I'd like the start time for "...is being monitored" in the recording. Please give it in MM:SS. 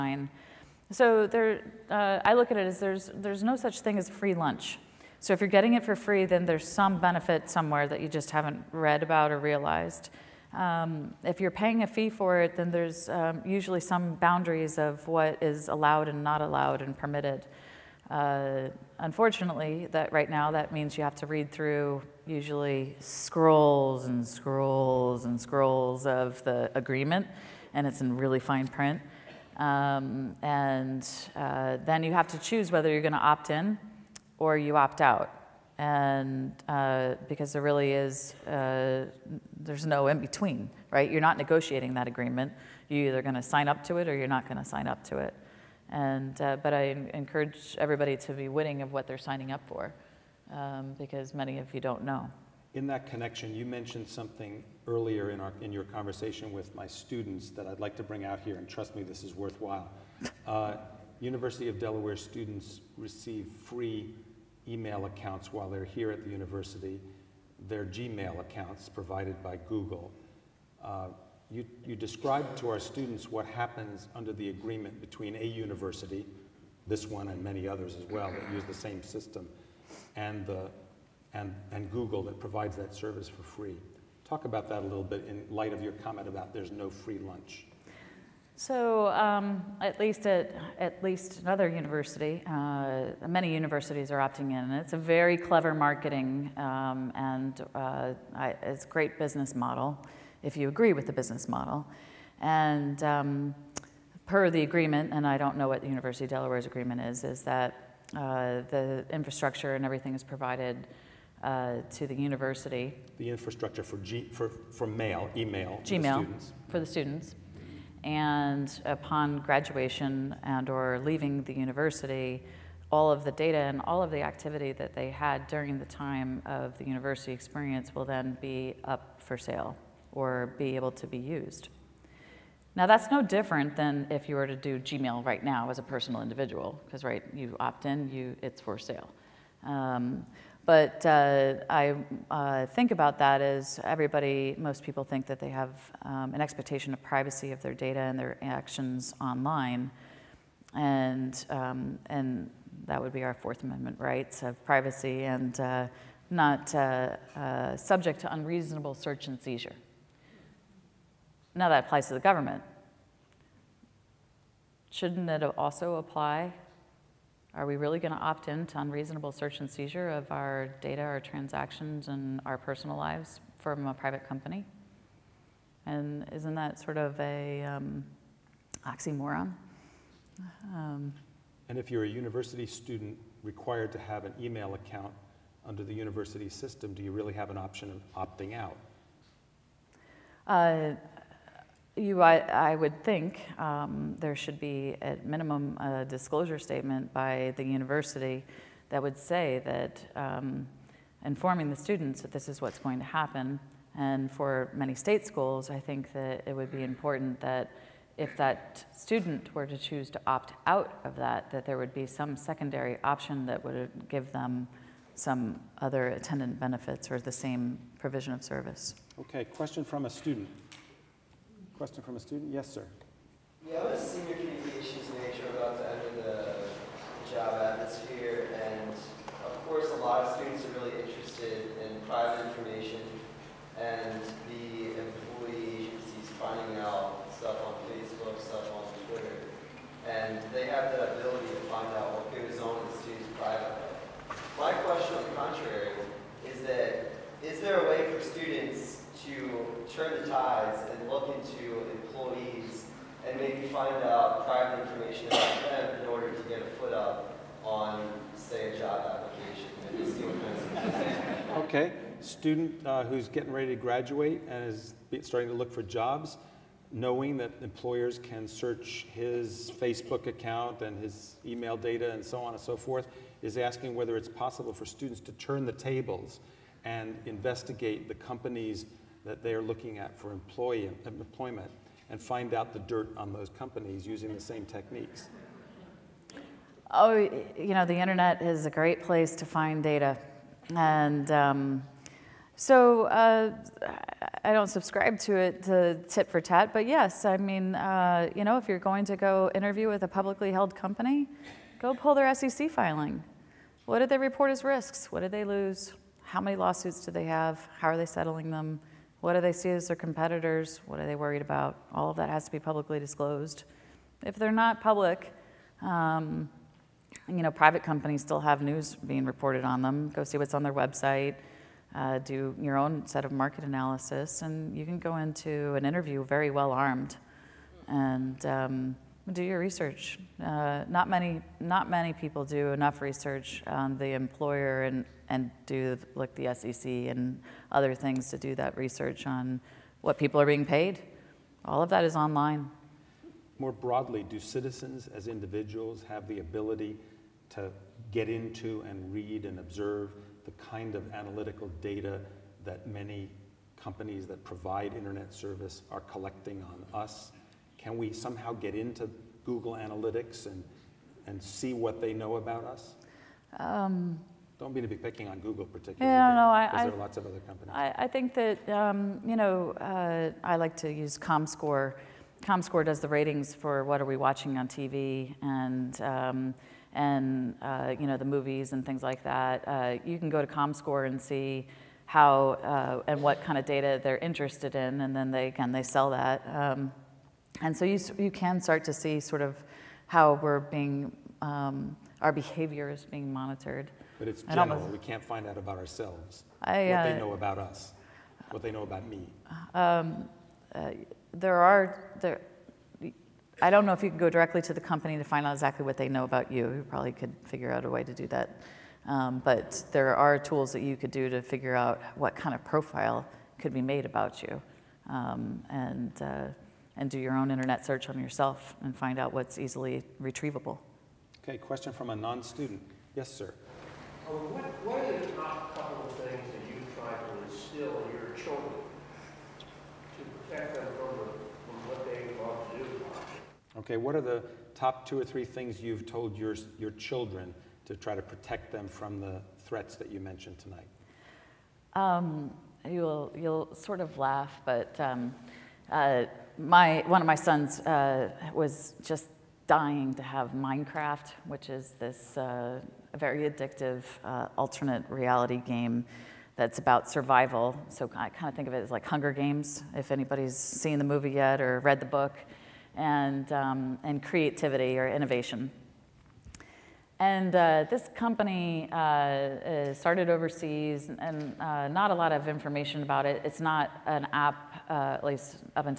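06:32.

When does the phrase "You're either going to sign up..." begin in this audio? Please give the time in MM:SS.
00:42.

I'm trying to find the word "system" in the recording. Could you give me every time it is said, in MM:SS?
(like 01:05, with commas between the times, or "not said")
01:19, 03:06.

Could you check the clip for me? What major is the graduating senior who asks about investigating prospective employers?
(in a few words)
communications.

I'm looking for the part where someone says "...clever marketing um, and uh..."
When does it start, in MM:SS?
01:35.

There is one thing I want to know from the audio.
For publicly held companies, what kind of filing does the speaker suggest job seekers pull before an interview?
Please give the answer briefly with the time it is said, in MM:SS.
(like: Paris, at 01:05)
SEC filing, at 05:02.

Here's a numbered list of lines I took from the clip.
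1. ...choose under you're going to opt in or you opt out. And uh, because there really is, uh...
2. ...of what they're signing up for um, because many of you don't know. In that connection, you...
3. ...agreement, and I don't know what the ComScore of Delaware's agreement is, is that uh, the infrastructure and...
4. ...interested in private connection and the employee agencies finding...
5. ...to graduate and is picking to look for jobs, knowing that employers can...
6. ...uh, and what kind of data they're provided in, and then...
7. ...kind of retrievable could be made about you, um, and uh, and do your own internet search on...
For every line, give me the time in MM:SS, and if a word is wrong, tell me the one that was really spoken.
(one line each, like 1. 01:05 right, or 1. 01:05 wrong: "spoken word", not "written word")
1. 00:32 wrong: "whether", not "under"
2. 00:48 right
3. 01:44 wrong: "University", not "ComScore"
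4. 03:51 wrong: "information", not "connection"
5. 04:23 wrong: "starting", not "picking"
6. 06:23 wrong: "interested", not "provided"
7. 06:52 wrong: "profile", not "retrievable".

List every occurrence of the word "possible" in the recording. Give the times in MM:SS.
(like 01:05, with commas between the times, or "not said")
04:34.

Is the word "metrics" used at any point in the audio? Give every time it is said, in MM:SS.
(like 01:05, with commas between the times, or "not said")
not said.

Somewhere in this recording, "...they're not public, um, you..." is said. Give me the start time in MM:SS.
05:14.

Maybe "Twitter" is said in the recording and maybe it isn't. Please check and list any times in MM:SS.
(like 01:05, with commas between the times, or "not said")
03:59.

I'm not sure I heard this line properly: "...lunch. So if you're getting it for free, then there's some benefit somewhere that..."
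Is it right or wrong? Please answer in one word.
right.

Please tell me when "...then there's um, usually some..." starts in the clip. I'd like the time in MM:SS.
00:12.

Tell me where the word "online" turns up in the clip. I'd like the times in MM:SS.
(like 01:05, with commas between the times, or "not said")
02:29, 05:42.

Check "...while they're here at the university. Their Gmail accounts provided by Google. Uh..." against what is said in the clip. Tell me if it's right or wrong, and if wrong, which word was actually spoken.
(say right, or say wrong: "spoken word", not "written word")
right.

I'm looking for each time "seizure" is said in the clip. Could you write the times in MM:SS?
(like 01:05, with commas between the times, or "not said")
02:39, 02:49.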